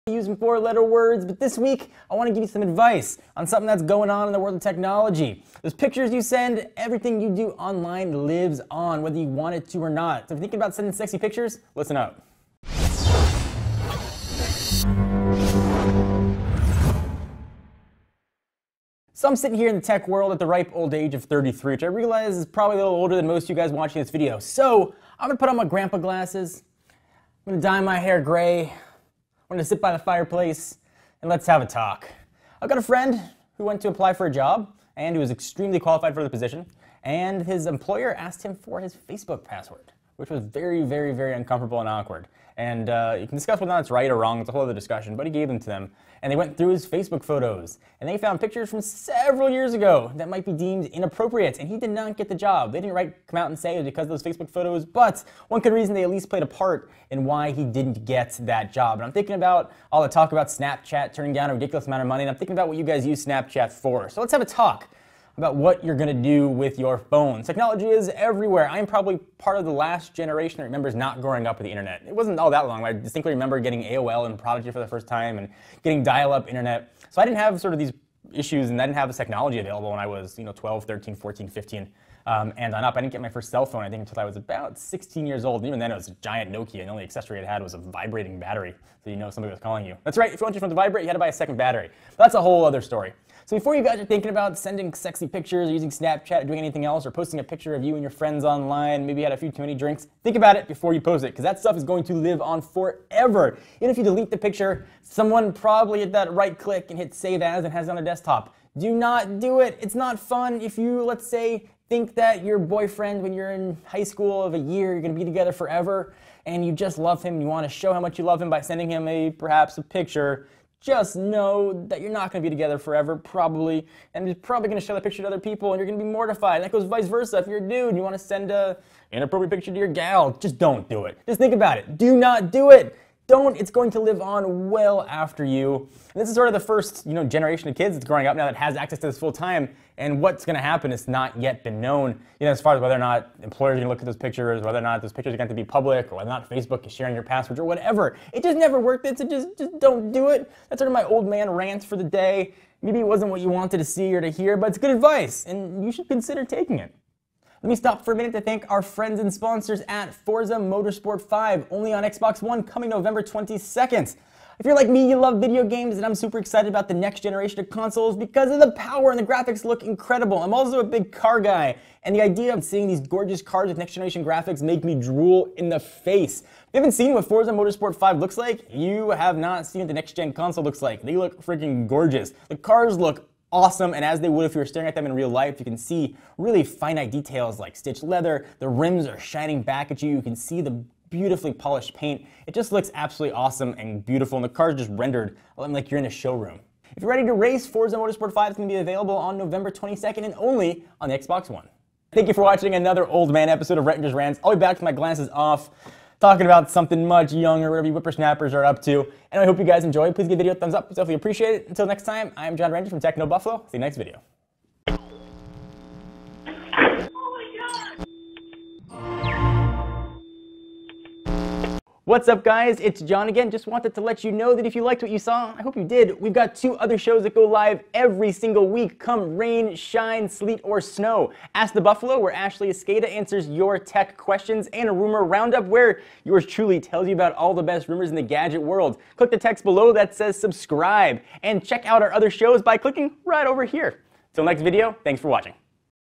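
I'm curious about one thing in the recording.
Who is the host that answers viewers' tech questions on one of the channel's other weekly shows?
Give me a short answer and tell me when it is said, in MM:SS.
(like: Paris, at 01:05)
Ashley Esqueda, at 03:52.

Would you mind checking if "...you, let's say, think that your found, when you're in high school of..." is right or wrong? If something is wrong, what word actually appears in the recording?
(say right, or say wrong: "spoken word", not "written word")
wrong: "boyfriend", not "found".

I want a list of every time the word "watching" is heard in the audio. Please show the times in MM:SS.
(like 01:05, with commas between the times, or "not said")
00:23, 03:22, 04:05.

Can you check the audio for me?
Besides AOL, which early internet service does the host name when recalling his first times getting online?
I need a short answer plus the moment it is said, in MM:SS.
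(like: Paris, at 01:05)
Prodigy, at 01:14.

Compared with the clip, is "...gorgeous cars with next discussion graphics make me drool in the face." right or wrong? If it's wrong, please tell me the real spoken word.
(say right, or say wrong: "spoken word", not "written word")
wrong: "generation", not "discussion".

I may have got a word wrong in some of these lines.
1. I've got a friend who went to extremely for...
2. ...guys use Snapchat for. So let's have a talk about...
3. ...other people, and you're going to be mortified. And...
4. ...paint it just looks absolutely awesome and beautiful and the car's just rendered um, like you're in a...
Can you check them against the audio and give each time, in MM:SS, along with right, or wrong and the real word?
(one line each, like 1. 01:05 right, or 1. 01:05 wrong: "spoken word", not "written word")
1. 00:32 wrong: "apply", not "extremely"
2. 01:02 right
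3. 02:05 right
4. 03:11 right.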